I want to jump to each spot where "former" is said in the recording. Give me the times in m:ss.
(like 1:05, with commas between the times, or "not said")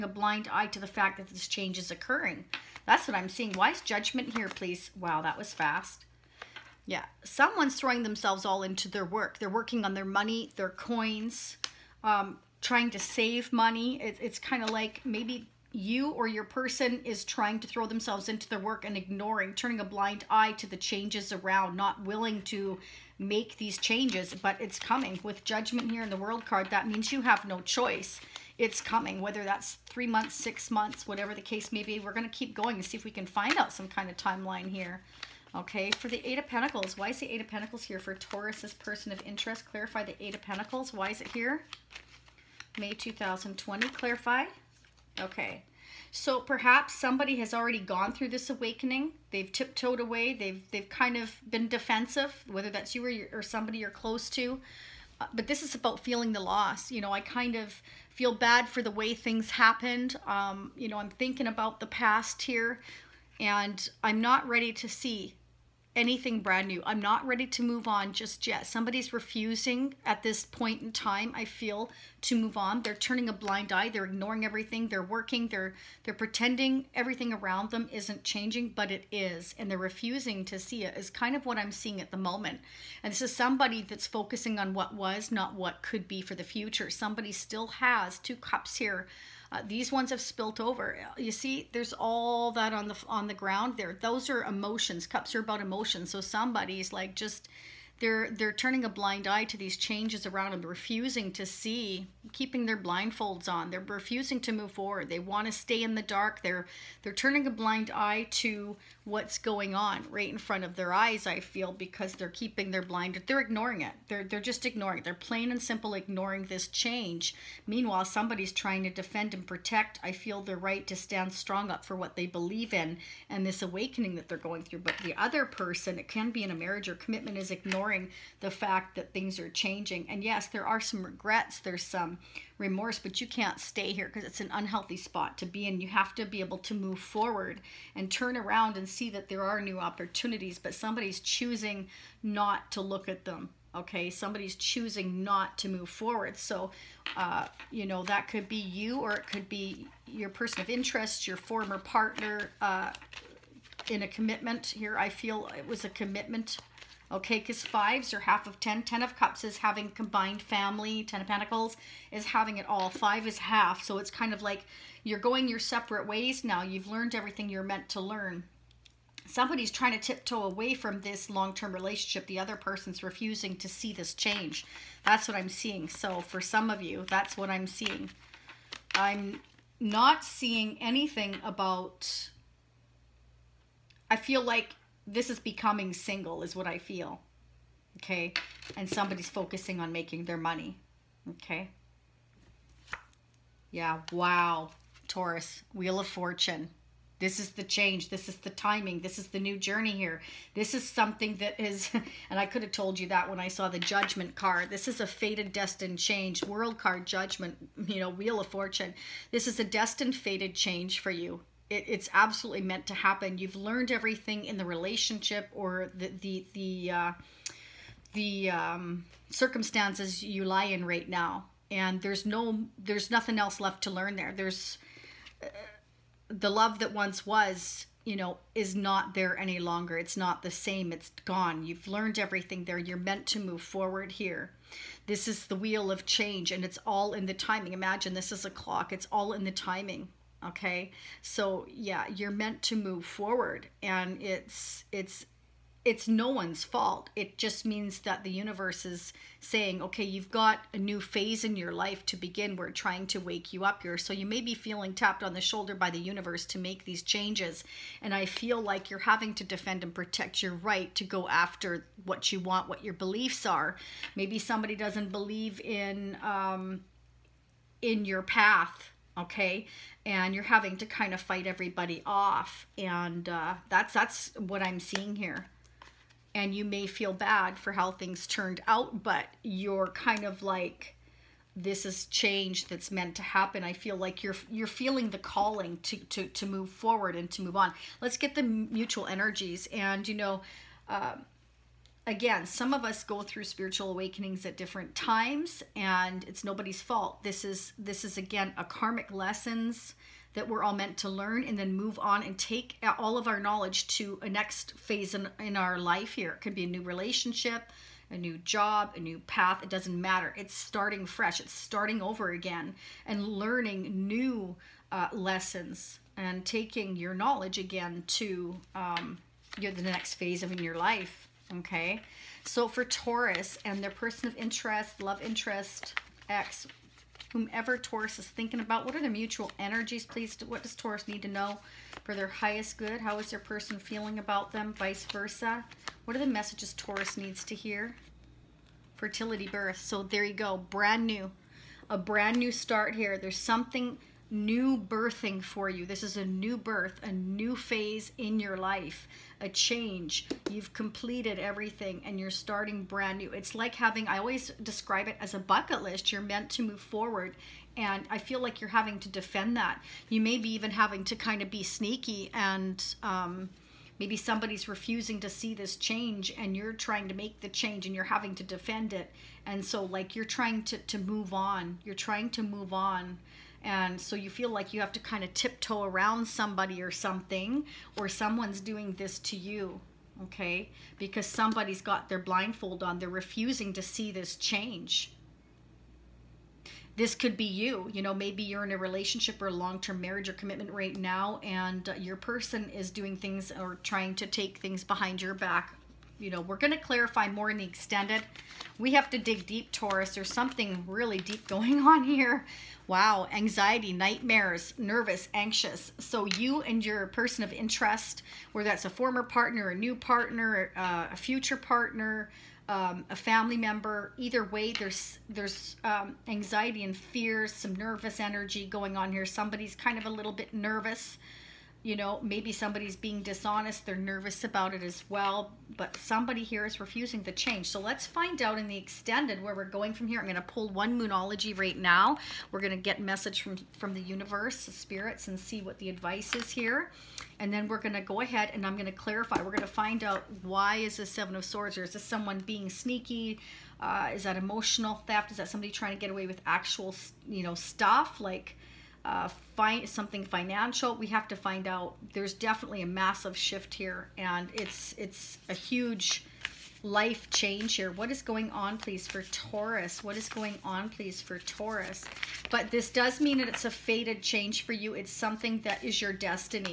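2:31, 6:48.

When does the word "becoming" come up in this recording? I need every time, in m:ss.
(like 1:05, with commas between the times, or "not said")
3:05.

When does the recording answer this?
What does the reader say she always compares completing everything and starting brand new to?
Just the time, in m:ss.
5:55.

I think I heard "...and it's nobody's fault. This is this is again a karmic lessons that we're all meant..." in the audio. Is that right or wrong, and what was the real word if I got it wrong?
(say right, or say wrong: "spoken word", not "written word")
right.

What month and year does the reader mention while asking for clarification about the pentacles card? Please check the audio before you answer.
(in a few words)
May 2020.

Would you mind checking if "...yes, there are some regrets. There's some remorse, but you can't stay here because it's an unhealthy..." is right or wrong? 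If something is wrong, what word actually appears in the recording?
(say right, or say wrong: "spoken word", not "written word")
right.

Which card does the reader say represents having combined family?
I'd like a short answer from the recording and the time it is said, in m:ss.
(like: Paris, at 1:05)
Ten of Cups, at 2:38.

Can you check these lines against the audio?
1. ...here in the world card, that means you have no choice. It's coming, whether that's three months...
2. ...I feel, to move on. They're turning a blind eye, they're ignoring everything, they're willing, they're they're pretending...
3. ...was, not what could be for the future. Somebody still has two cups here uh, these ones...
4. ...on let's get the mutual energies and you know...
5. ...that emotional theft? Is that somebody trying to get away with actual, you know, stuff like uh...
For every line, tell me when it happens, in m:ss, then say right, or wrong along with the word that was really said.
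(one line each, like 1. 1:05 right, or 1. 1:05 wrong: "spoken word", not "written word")
1. 0:25 right
2. 1:11 wrong: "working", not "willing"
3. 1:24 right
4. 4:47 right
5. 7:24 right.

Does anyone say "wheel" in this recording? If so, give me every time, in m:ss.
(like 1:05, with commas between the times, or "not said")
3:15, 3:28, 3:55.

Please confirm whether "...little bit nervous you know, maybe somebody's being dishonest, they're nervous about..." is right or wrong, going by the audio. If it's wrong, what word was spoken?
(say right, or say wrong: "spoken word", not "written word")
right.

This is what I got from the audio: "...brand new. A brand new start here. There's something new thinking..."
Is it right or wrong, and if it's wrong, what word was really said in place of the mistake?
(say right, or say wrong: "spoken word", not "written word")
wrong: "birthing", not "thinking".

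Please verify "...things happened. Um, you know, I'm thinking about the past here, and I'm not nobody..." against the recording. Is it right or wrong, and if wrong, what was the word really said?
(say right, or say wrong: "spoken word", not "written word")
wrong: "ready", not "nobody".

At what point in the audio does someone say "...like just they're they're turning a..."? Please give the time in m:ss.
1:36.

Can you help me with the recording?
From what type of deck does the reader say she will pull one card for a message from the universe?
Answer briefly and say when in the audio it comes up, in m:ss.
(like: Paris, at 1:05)
Moonology, at 7:10.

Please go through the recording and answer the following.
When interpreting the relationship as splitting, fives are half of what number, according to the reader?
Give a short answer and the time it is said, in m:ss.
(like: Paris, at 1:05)
10, at 2:37.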